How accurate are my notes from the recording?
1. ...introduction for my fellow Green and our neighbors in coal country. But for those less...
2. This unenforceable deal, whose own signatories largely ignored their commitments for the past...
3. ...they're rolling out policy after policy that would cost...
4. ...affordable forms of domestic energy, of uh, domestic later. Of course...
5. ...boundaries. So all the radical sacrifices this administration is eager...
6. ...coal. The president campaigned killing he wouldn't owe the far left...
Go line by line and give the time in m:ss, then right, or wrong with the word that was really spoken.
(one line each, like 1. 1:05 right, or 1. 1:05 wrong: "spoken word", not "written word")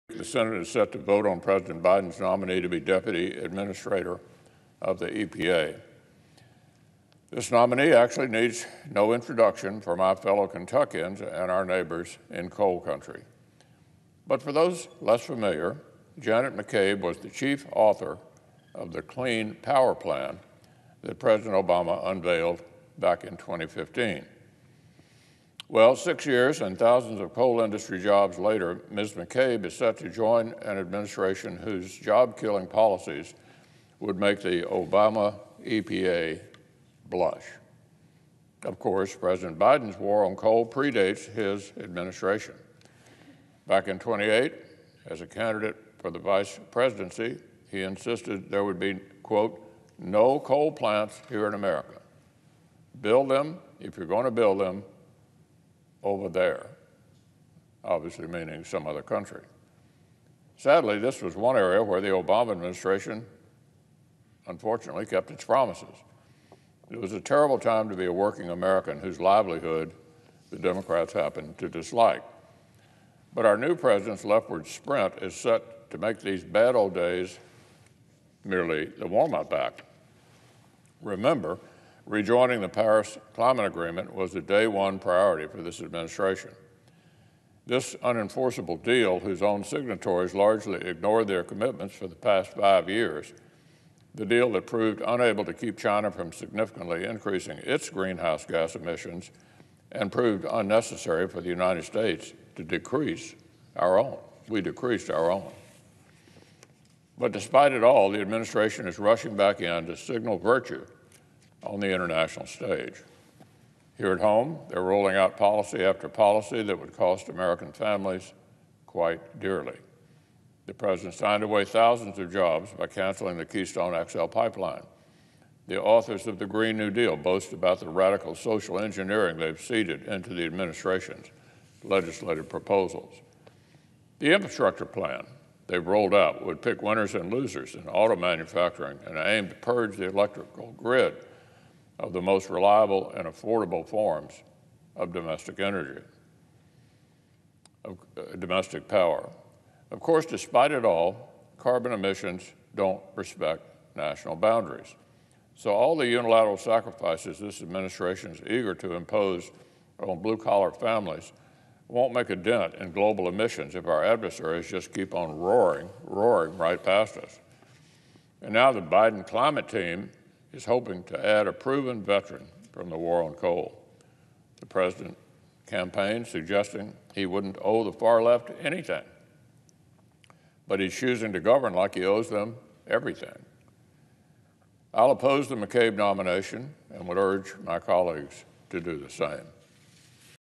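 1. 0:09 wrong: "Kentuckians", not "Green"
2. 1:27 right
3. 1:54 right
4. 2:23 wrong: "power", not "later"
5. 2:34 wrong: "unilateral", not "radical"
6. 2:53 wrong: "suggesting", not "killing".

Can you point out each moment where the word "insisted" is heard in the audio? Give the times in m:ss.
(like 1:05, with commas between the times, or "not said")
0:47.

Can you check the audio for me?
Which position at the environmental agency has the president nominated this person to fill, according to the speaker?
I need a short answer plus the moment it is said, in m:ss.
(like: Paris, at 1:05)
Deputy Administrator, at 0:02.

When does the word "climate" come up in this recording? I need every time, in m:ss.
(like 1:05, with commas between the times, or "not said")
1:23, 2:49.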